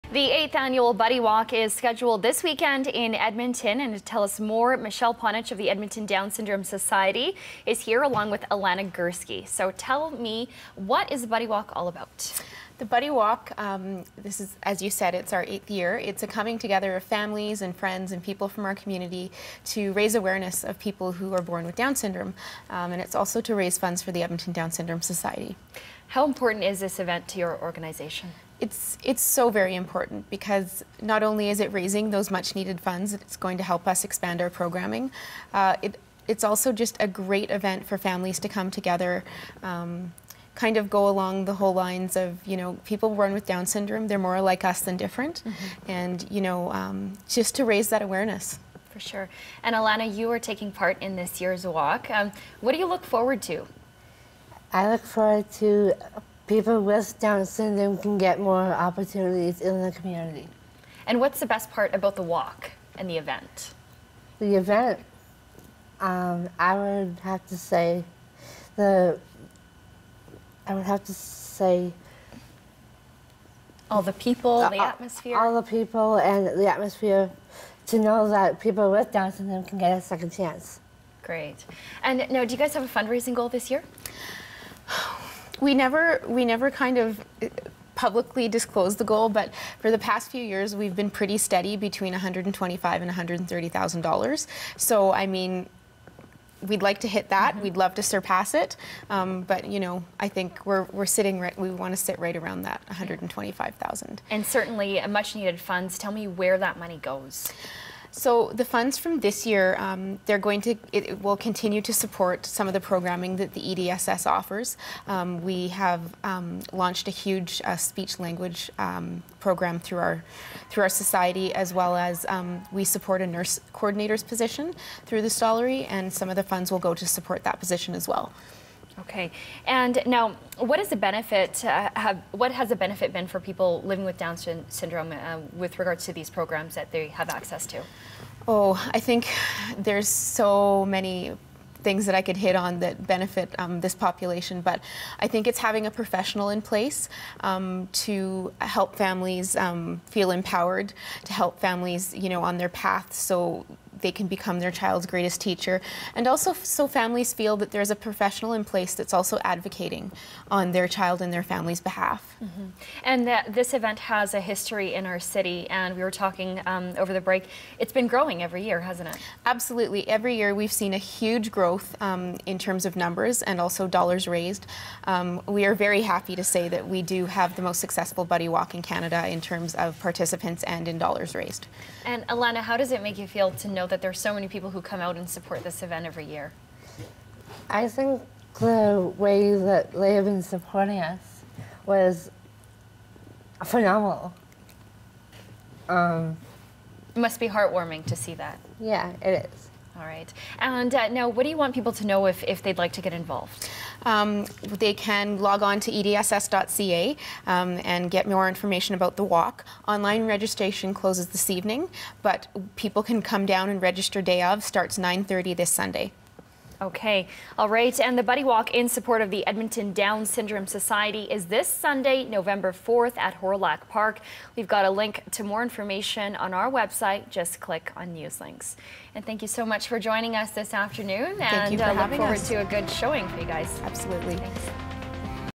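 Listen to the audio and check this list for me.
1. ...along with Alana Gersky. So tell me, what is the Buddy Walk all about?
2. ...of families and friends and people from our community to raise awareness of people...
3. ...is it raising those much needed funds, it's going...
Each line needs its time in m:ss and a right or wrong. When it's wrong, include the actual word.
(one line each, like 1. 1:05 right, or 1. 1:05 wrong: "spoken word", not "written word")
1. 0:08 right
2. 0:16 right
3. 0:31 right.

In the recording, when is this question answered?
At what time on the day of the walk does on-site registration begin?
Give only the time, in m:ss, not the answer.
3:34.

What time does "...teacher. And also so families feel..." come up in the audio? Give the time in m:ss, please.
2:35.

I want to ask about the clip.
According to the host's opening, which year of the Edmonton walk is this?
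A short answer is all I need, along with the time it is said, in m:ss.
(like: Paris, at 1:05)
8th, at 0:00.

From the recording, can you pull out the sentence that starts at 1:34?
So I mean, we'd like to hit that.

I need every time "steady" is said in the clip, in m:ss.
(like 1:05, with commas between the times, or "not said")
1:31.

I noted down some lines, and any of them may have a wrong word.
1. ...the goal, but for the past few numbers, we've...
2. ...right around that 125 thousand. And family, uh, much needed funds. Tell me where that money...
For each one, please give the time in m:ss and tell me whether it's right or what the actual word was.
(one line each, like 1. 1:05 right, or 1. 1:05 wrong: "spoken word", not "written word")
1. 1:28 wrong: "years", not "numbers"
2. 1:42 wrong: "certainly", not "family".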